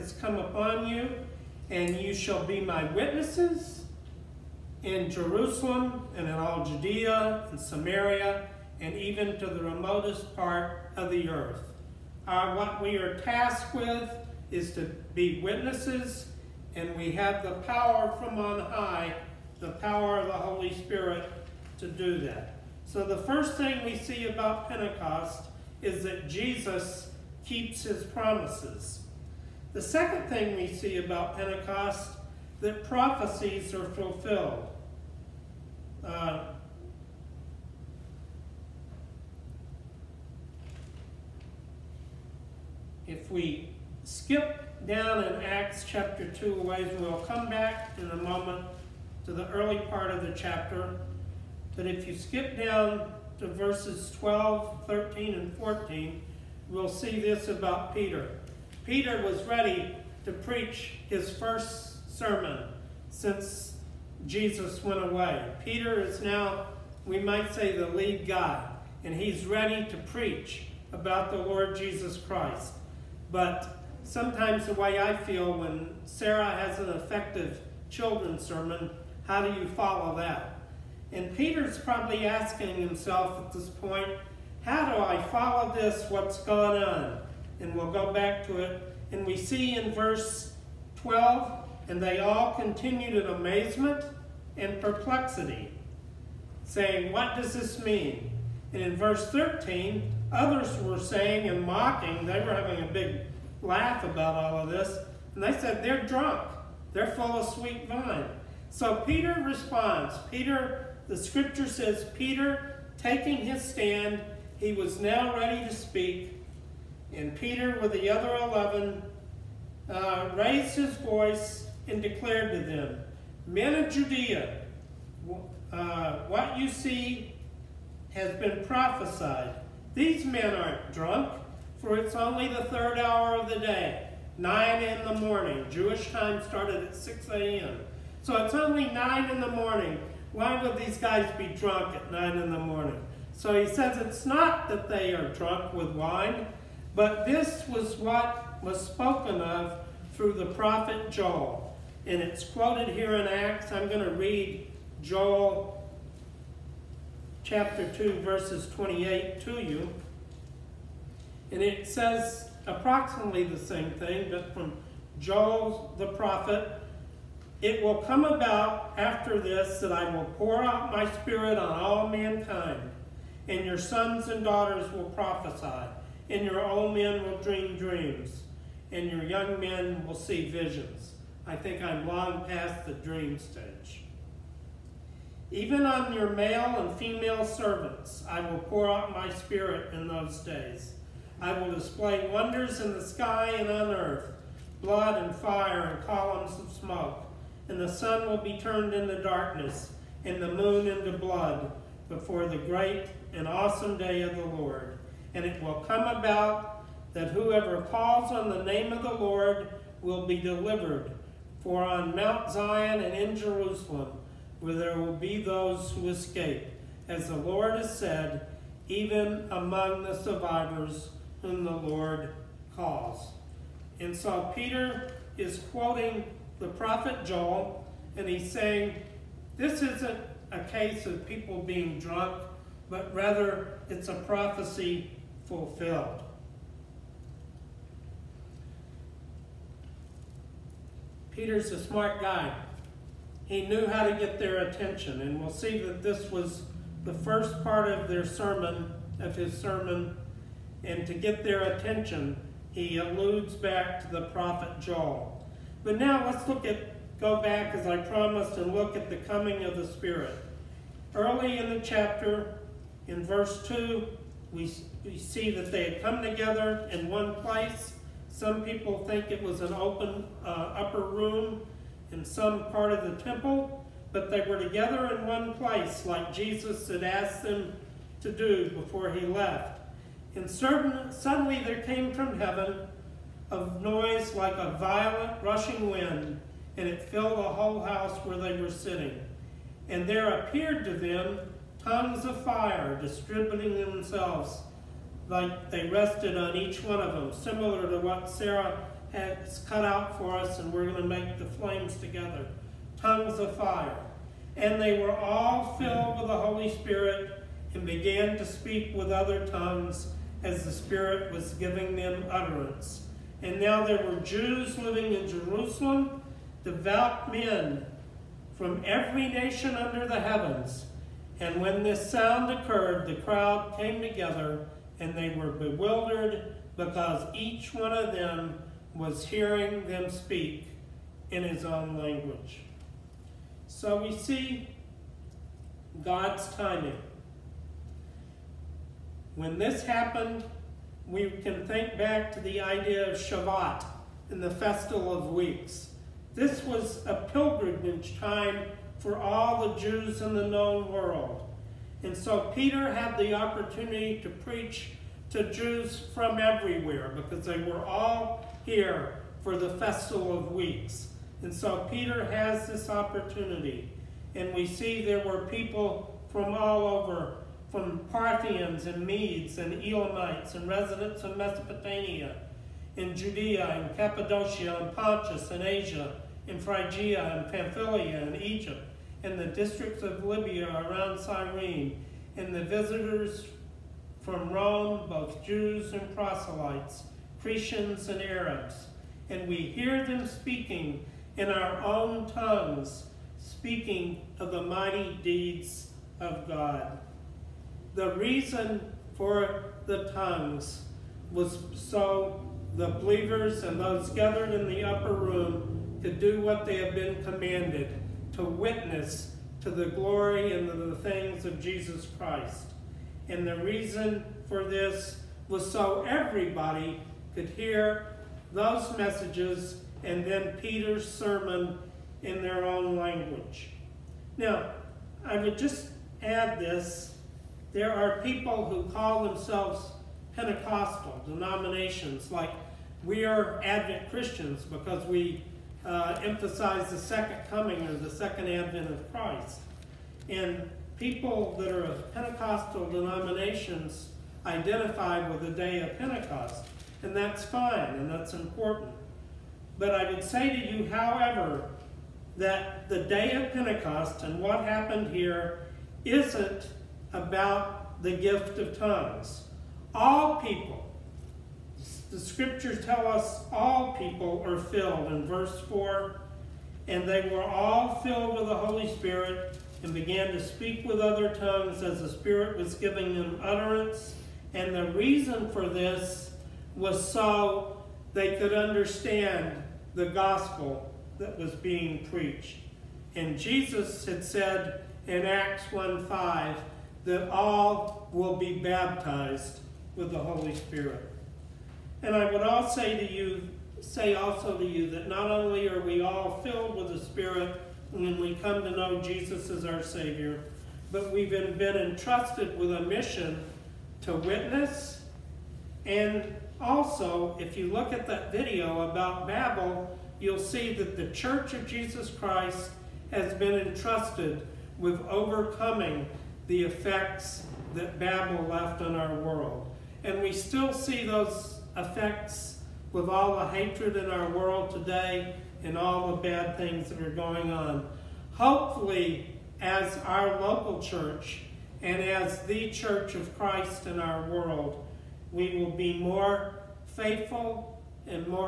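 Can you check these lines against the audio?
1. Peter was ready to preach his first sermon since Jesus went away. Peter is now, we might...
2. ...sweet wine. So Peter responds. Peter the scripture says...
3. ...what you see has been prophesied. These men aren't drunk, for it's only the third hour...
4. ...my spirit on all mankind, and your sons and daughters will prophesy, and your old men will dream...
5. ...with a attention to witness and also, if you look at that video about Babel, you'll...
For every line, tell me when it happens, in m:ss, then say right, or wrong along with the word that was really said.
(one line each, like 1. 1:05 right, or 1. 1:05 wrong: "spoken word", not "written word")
1. 0:58 right
2. 1:47 right
3. 2:06 right
4. 2:50 right
5. 8:22 wrong: "mission", not "attention".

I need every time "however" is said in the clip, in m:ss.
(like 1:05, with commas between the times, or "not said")
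7:30.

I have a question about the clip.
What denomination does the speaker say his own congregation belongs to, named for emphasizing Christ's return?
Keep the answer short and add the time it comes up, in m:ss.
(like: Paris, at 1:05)
Advent Christians, at 7:13.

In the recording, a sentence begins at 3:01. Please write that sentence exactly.
I think I'm long past the dream stage.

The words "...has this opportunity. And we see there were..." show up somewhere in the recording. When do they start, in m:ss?
6:02.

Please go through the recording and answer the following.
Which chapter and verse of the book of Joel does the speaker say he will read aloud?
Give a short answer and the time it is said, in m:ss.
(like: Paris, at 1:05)
Chapter 2, verse 28, at 2:37.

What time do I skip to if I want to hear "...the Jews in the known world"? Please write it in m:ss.
5:49.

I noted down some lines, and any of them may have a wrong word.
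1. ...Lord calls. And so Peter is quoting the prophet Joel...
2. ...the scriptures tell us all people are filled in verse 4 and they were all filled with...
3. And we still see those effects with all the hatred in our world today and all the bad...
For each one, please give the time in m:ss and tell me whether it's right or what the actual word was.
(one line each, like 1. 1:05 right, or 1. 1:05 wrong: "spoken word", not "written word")
1. 3:41 right
2. 7:42 right
3. 8:40 right.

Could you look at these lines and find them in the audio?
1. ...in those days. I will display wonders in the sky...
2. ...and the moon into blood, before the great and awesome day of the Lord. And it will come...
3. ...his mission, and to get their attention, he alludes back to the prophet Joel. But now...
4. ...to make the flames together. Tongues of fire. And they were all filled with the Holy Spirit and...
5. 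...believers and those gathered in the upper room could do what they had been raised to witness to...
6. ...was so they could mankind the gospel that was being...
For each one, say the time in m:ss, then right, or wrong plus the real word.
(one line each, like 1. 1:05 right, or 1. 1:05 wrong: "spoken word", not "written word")
1. 3:09 right
2. 3:20 right
3. 4:09 wrong: "sermon", not "mission"
4. 5:01 right
5. 6:42 wrong: "commanded", not "raised"
6. 7:56 wrong: "understand", not "mankind".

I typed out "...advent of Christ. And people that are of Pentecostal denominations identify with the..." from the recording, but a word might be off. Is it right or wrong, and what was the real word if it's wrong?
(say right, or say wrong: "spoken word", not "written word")
right.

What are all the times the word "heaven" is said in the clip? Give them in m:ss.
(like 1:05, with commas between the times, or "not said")
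4:42, 5:20.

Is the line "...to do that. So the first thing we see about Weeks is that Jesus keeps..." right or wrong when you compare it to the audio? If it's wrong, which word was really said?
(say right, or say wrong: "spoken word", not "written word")
wrong: "Pentecost", not "Weeks".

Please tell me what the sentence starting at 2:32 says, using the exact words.
And it's quoted here in Acts.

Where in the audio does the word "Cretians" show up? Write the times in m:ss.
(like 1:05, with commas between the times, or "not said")
6:27.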